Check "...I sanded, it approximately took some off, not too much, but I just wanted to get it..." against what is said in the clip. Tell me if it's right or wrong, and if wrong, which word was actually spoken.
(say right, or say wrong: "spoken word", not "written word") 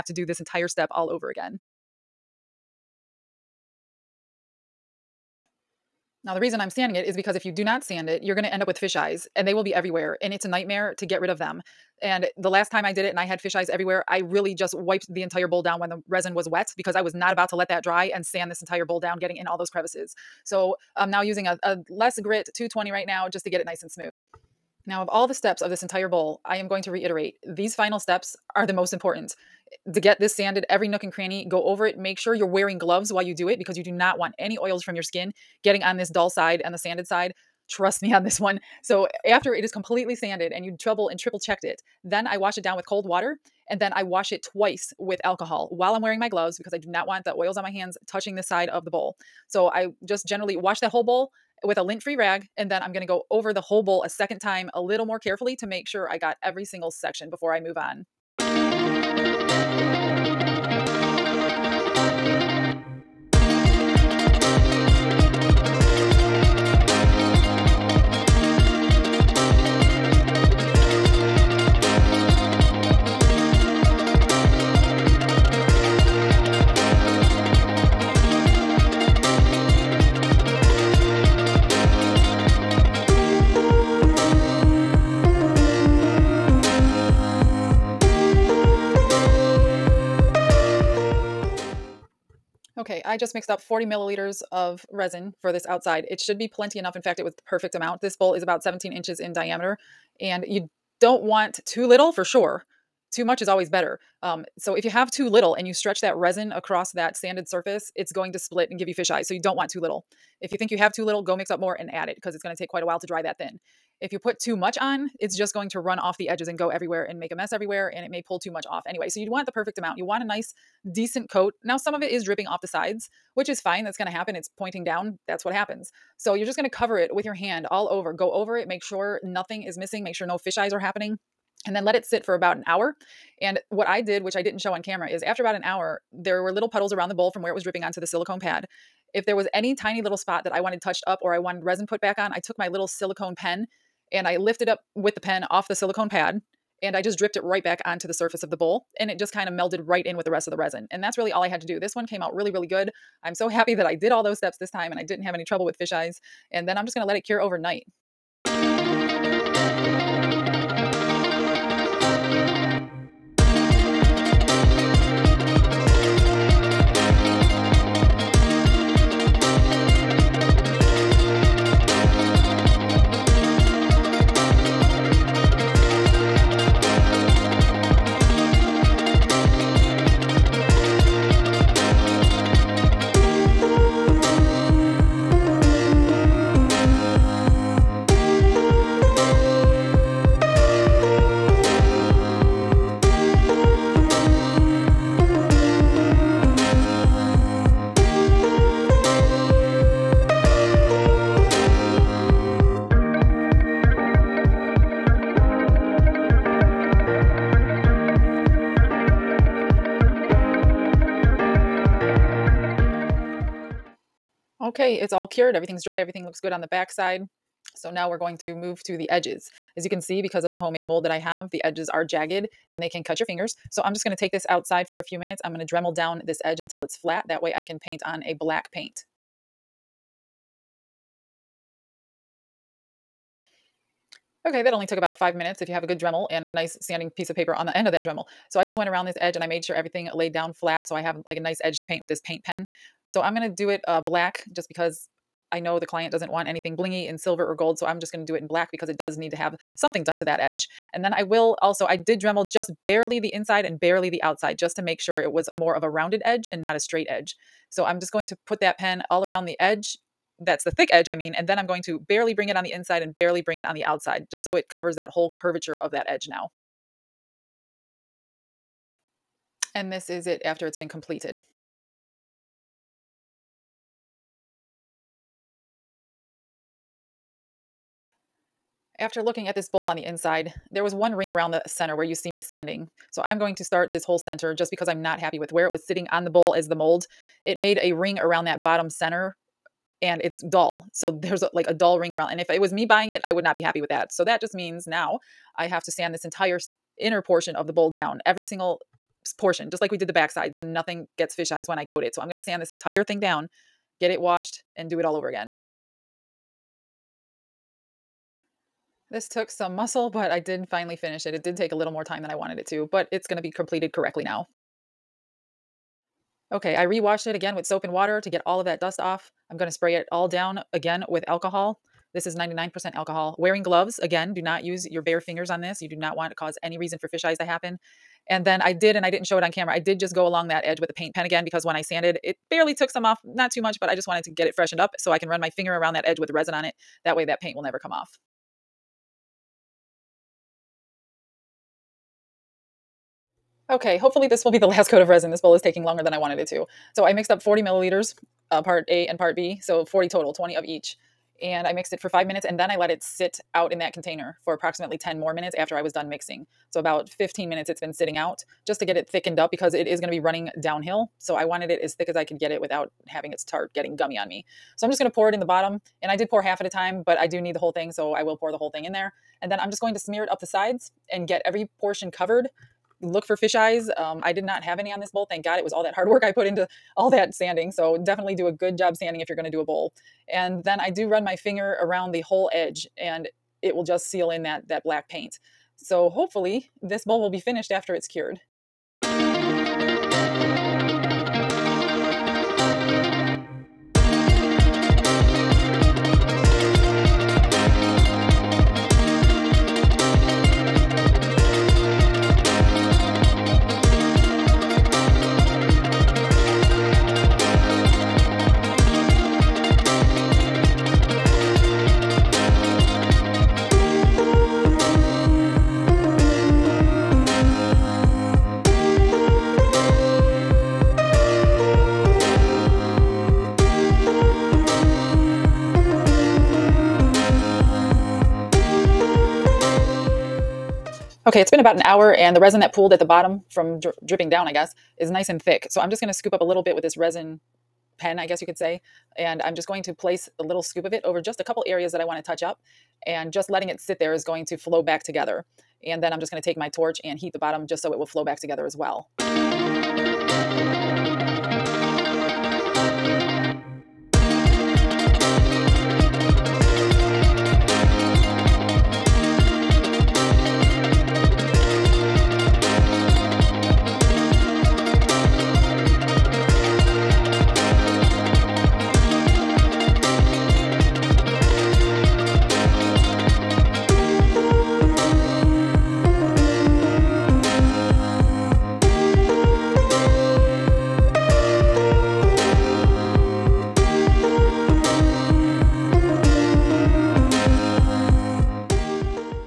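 wrong: "barely", not "approximately".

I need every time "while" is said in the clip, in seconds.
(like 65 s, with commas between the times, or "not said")
33 s, 45 s, 112 s.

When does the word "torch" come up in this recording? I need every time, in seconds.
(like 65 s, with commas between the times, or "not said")
446 s.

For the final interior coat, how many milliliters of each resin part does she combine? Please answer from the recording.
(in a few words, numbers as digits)
20.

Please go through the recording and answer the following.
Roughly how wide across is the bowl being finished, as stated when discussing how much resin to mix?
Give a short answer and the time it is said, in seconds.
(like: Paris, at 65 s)
17 inches, at 98 s.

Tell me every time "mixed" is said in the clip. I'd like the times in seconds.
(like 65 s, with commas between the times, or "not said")
93 s, 347 s, 351 s.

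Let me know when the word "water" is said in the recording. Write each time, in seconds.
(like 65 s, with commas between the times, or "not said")
43 s, 317 s.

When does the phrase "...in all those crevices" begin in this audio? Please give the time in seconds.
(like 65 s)
19 s.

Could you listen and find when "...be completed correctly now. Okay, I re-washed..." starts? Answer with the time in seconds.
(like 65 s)
313 s.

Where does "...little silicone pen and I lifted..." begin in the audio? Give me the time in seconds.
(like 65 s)
142 s.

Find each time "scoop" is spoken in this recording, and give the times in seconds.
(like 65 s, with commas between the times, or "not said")
436 s, 440 s.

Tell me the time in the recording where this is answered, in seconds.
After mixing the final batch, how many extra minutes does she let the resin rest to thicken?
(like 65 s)
354 s.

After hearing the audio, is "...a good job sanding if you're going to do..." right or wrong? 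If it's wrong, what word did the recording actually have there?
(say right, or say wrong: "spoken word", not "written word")
right.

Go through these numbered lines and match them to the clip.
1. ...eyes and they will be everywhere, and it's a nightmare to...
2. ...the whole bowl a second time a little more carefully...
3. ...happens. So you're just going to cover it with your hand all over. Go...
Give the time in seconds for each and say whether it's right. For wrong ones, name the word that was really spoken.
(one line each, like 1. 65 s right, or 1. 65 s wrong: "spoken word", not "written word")
1. 8 s right
2. 53 s right
3. 125 s right.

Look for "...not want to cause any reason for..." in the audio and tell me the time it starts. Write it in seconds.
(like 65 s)
325 s.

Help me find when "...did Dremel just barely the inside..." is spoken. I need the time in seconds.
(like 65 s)
251 s.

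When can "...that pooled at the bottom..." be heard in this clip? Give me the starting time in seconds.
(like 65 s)
432 s.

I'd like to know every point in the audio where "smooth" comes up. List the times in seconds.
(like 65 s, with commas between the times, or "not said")
23 s.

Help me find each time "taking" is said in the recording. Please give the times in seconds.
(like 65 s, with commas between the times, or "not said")
345 s.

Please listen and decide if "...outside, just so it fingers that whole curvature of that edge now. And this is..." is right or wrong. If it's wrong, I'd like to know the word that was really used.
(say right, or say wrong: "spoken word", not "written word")
wrong: "covers", not "fingers".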